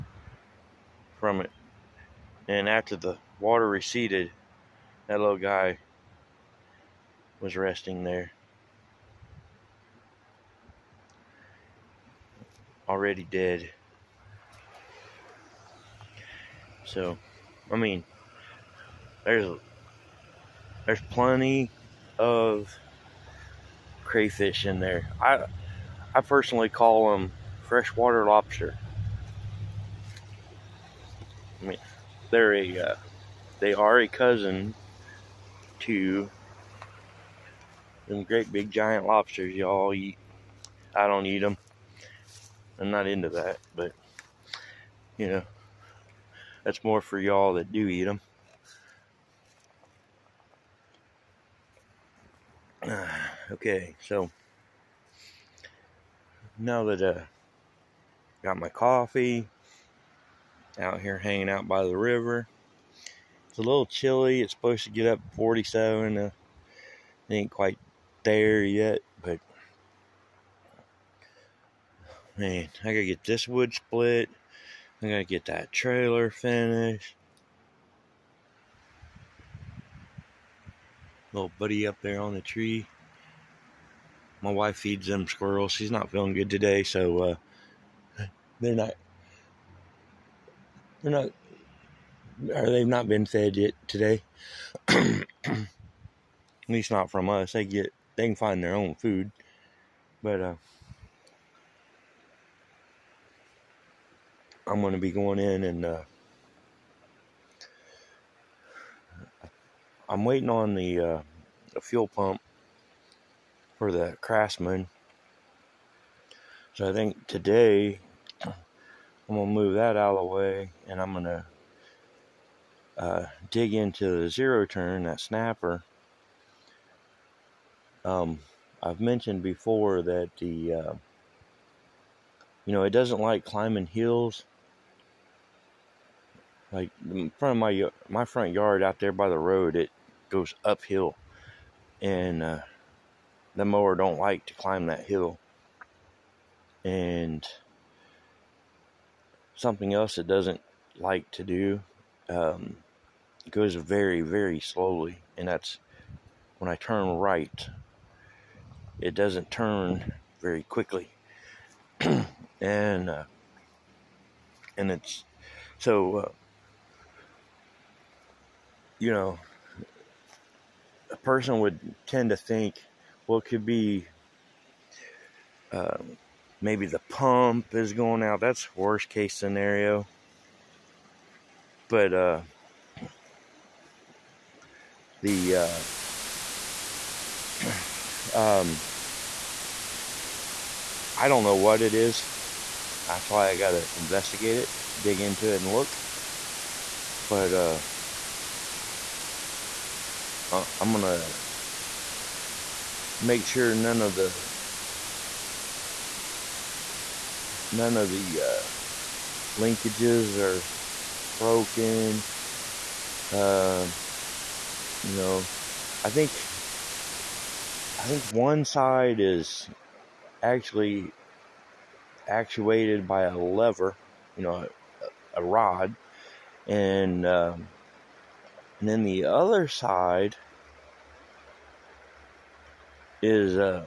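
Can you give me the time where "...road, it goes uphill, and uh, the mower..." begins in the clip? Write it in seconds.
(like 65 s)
139 s.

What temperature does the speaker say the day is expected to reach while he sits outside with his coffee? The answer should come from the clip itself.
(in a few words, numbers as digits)
47.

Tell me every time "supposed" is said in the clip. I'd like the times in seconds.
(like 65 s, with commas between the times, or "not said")
64 s.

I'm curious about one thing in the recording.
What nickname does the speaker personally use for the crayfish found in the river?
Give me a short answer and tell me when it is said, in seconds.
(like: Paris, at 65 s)
freshwater lobster, at 27 s.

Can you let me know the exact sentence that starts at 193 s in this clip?
That's why I gotta investigate it, dig into it, and look.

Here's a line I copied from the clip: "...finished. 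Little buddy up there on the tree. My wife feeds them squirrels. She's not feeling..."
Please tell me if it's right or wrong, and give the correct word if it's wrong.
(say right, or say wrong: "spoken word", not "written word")
right.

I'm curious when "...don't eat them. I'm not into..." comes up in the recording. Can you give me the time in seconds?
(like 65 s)
41 s.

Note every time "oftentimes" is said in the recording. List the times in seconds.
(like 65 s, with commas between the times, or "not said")
not said.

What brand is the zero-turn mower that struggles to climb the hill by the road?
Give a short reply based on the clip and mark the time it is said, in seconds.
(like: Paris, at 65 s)
Snapper, at 125 s.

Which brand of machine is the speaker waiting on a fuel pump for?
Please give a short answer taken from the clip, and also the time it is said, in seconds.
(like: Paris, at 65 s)
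Craftsman, at 114 s.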